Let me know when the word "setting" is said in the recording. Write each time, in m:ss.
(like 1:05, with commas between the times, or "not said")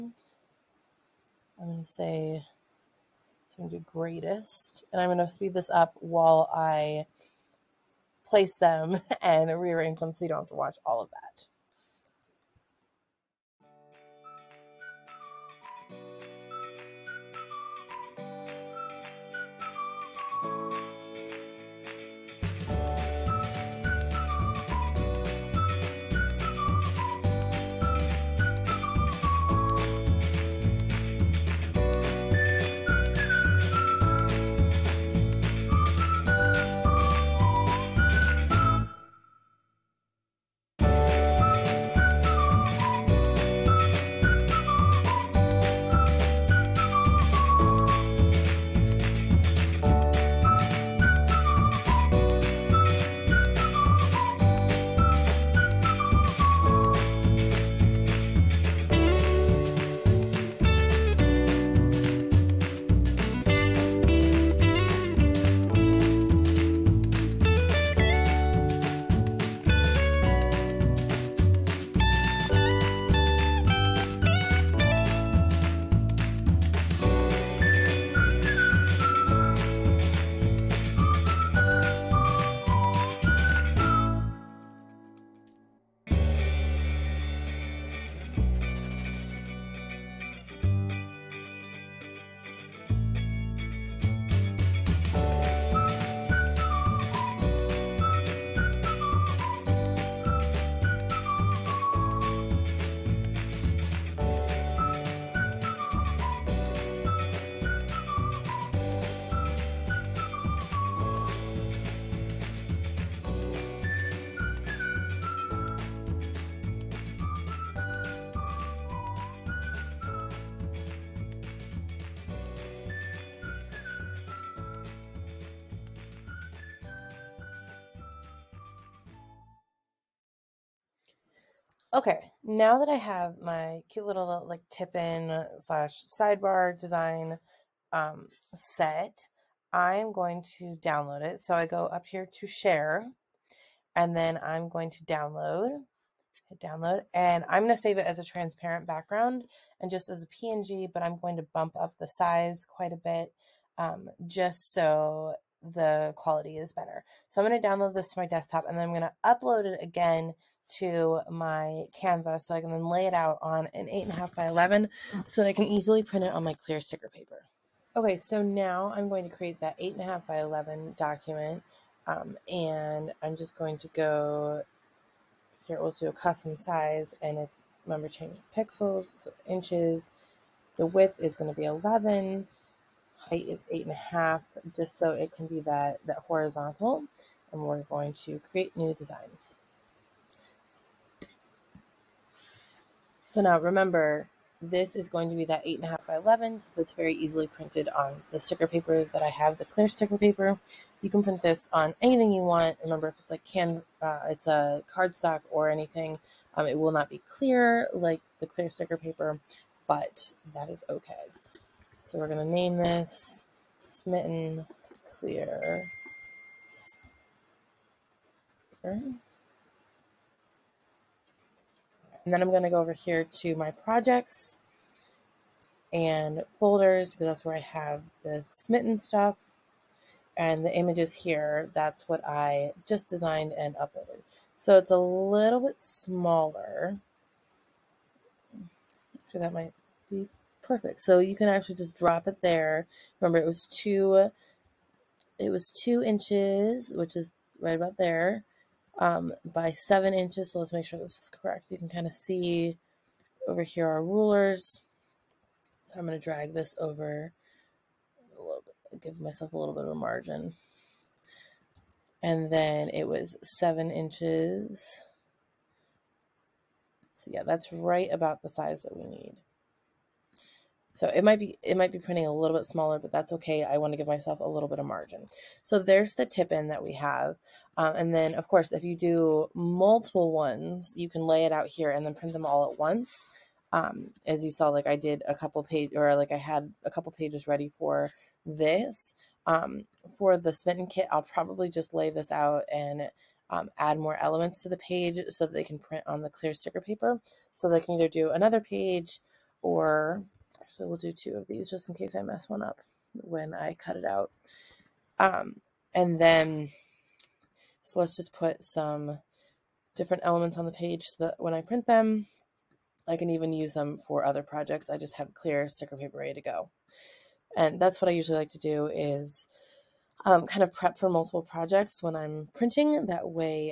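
not said.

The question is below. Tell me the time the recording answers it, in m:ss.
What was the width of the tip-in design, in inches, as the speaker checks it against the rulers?
4:05.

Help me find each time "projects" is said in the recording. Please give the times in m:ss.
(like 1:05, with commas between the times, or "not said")
3:43, 5:14, 5:21.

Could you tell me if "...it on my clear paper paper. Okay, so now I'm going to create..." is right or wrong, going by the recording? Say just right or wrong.
wrong.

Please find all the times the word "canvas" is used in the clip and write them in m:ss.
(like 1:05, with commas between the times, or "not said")
2:41.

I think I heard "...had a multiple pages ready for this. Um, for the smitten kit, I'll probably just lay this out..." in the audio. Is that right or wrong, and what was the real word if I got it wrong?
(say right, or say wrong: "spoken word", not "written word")
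wrong: "couple", not "multiple".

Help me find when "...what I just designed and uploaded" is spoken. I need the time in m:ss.
3:52.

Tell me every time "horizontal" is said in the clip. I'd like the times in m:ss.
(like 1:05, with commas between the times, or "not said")
3:06.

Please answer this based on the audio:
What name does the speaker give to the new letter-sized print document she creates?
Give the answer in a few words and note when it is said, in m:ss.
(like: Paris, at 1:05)
Smitten Clear Sticker, at 3:33.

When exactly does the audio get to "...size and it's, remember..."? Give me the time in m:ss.
2:56.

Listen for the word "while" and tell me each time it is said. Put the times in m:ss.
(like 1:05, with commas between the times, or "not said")
0:06.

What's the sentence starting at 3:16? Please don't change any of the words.
So that's very easily printed on the sticker paper that I have, the clear sticker paper.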